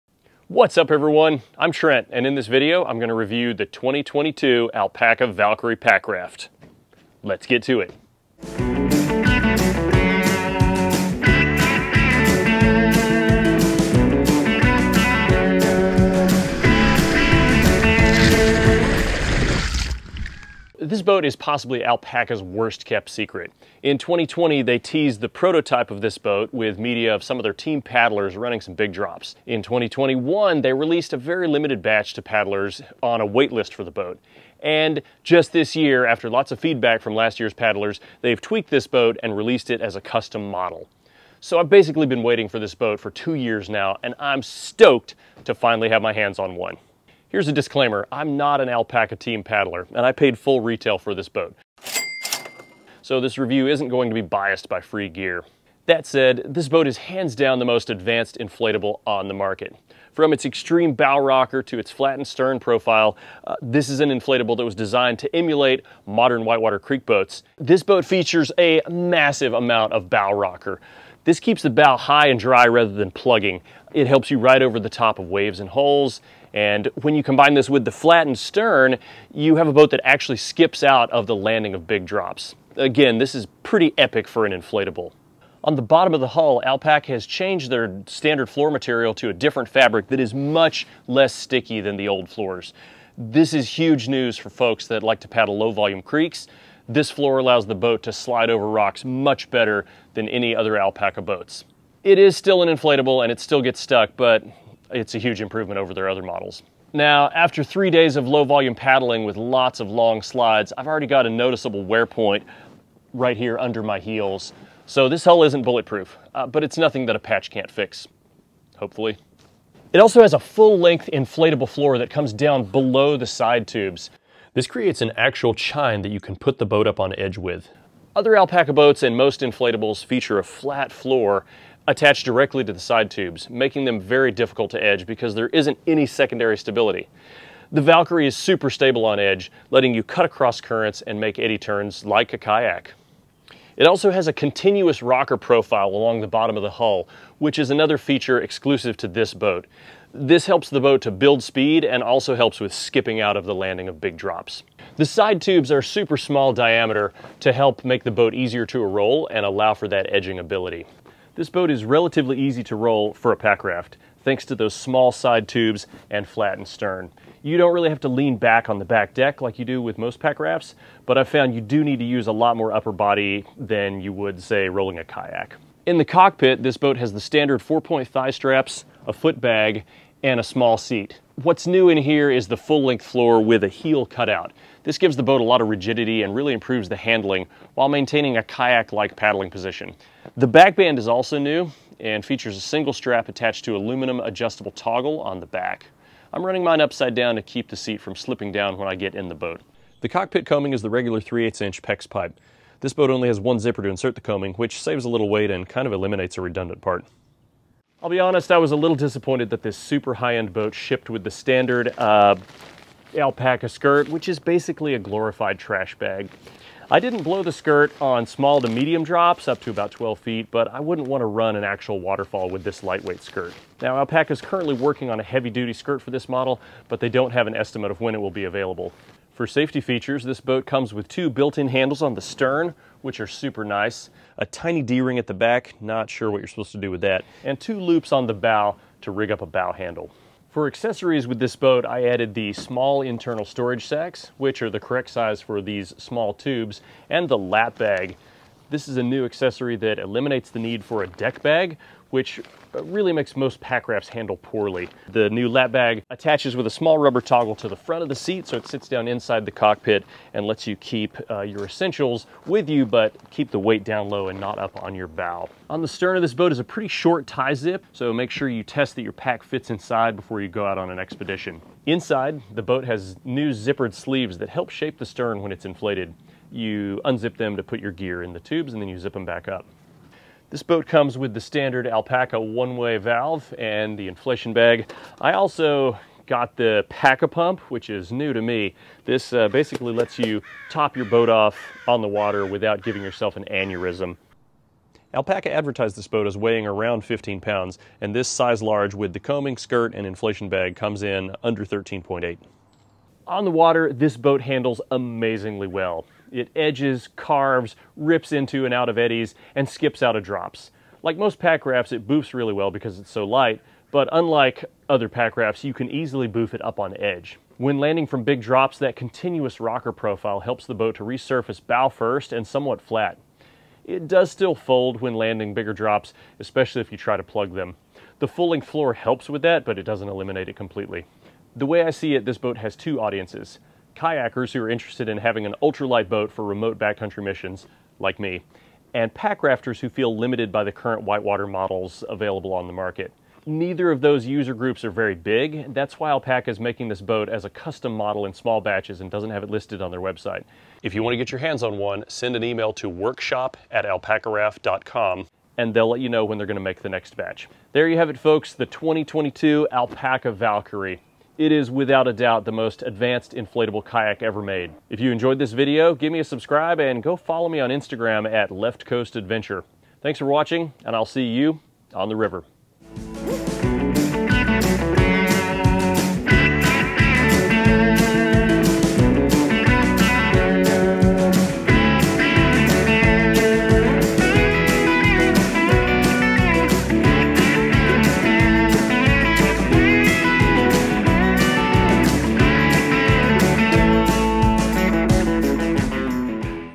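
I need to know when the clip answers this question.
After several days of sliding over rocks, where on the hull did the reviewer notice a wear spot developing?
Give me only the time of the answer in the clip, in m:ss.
1:53.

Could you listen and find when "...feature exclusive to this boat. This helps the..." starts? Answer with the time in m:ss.
2:27.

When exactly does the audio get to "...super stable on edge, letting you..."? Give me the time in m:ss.
2:18.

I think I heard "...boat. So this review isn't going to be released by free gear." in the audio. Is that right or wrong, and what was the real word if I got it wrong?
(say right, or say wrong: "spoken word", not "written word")
wrong: "biased", not "released".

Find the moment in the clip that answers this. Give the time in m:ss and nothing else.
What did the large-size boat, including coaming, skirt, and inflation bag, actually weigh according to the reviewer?
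5:01.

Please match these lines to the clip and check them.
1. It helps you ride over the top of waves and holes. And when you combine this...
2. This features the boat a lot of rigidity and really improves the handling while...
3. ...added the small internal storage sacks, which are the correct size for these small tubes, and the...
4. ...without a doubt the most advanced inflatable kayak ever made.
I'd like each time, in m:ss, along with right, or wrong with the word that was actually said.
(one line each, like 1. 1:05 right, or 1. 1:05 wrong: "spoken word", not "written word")
1. 1:13 right
2. 3:04 wrong: "gives", not "features"
3. 4:02 right
4. 6:01 right.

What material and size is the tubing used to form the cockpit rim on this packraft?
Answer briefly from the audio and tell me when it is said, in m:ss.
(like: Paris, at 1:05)
3/8 inch PEX pipe, at 3:21.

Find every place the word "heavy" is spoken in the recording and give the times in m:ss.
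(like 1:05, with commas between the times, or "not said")
3:45.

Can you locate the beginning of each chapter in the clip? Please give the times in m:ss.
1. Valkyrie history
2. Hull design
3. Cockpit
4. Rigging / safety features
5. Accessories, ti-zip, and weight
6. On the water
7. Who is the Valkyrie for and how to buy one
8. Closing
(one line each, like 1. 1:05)
1. 0:20
2. 1:08
3. 2:55
4. 3:49
5. 4:00
6. 5:02
7. 5:33
8. 5:57.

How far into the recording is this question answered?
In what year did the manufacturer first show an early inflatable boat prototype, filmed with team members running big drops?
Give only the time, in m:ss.
0:23.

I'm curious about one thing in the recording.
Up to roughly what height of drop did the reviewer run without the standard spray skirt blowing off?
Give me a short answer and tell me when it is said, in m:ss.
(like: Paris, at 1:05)
12 feet, at 3:39.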